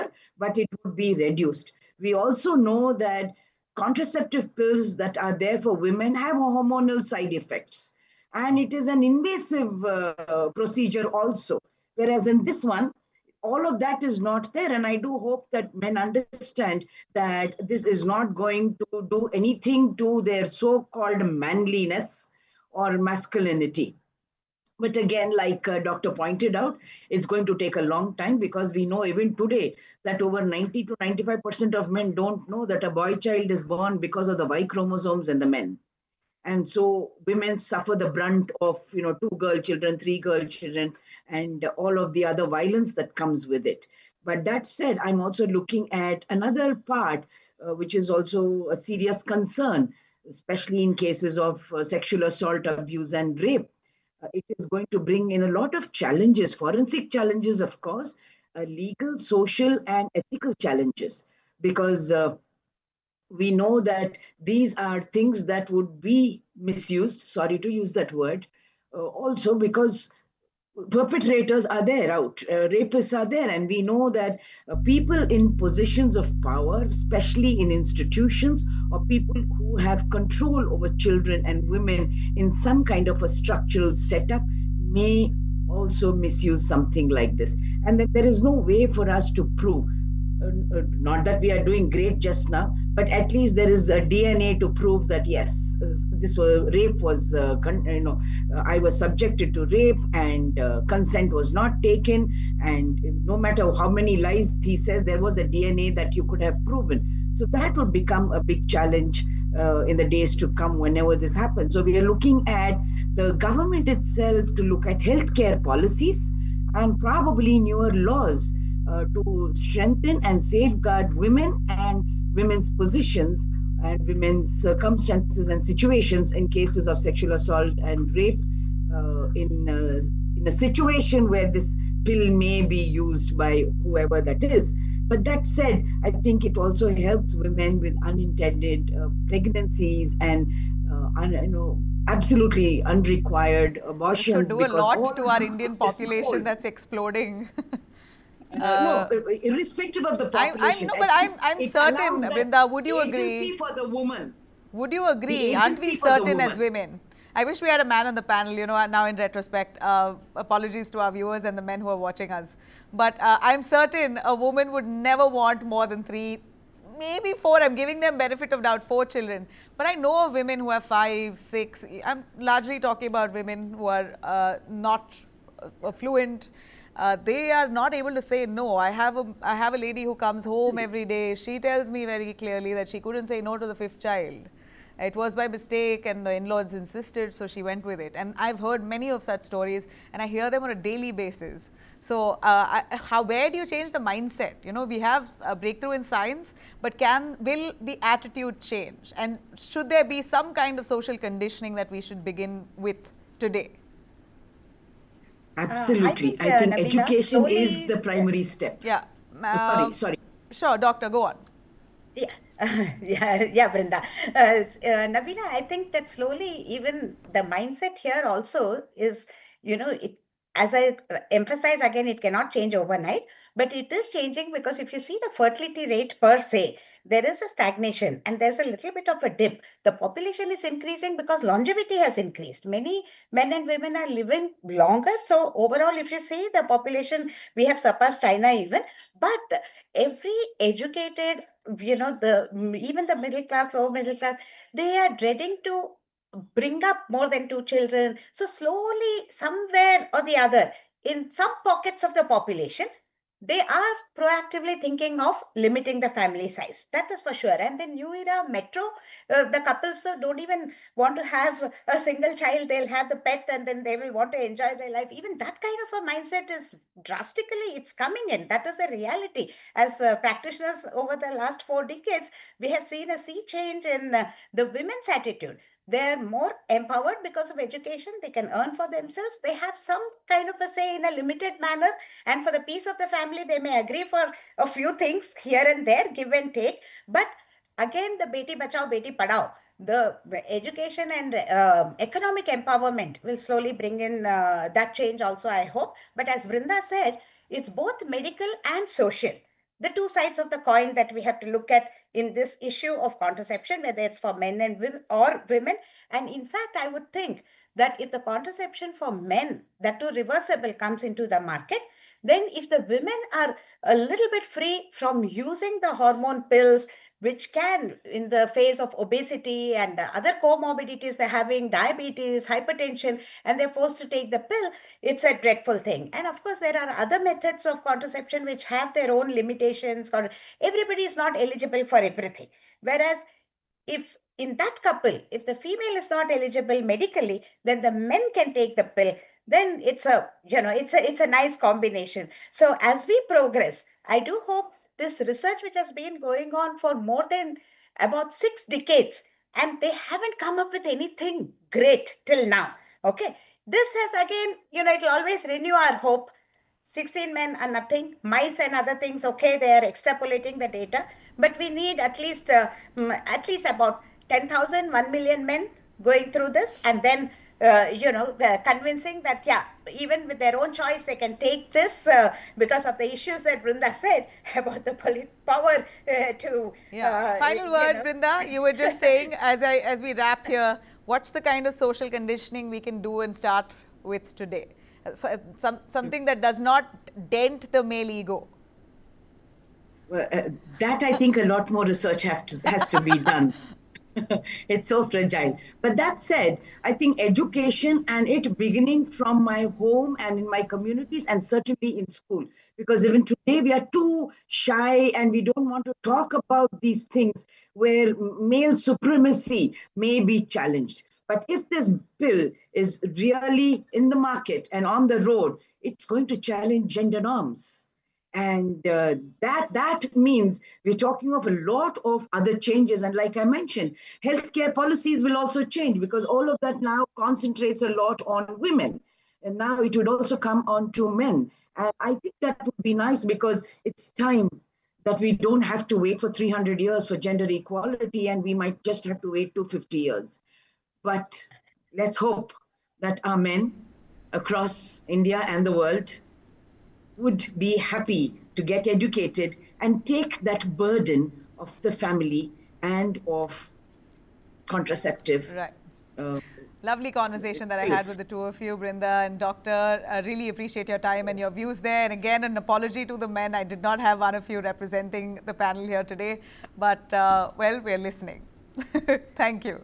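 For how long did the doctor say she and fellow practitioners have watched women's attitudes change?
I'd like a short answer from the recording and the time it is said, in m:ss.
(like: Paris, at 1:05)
four decades, at 4:31.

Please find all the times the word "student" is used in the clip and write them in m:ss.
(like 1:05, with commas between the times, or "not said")
not said.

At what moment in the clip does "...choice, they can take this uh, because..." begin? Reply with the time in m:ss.
6:10.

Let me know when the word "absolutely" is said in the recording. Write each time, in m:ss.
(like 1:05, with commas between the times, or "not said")
2:22, 3:25.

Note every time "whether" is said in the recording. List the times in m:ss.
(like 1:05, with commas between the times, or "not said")
5:03.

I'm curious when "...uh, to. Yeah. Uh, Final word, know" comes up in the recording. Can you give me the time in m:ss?
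6:16.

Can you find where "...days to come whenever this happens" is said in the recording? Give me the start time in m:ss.
1:50.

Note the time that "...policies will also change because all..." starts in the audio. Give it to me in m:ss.
7:04.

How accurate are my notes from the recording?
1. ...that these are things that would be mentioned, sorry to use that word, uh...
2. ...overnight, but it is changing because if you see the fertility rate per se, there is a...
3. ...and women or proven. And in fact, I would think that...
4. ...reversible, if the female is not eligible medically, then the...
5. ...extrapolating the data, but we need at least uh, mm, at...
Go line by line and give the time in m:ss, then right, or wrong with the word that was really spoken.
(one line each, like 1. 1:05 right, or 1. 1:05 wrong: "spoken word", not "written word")
1. 1:03 wrong: "misused", not "mentioned"
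2. 3:42 right
3. 5:04 wrong: "women", not "proven"
4. 5:34 wrong: "couple", not "reversible"
5. 5:59 right.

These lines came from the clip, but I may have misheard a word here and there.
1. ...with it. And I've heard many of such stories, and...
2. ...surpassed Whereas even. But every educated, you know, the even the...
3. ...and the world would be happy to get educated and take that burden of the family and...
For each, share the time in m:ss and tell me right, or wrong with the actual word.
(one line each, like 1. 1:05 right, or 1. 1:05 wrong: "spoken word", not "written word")
1. 3:07 right
2. 3:57 wrong: "China", not "Whereas"
3. 7:25 right.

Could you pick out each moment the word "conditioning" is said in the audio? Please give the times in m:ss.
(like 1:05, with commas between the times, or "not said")
3:21, 6:22.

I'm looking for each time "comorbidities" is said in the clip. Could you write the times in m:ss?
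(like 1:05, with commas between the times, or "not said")
5:20.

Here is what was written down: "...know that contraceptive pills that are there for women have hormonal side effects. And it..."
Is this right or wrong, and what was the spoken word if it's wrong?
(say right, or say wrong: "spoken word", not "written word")
right.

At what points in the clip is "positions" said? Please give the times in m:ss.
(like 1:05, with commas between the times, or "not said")
1:15, 2:02.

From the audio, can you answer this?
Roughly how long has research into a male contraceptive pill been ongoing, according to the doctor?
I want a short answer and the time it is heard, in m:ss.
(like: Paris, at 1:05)
six decades, at 5:48.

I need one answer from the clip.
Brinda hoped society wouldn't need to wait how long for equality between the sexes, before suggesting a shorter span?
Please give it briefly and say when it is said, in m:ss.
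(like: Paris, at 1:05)
300 years, at 7:16.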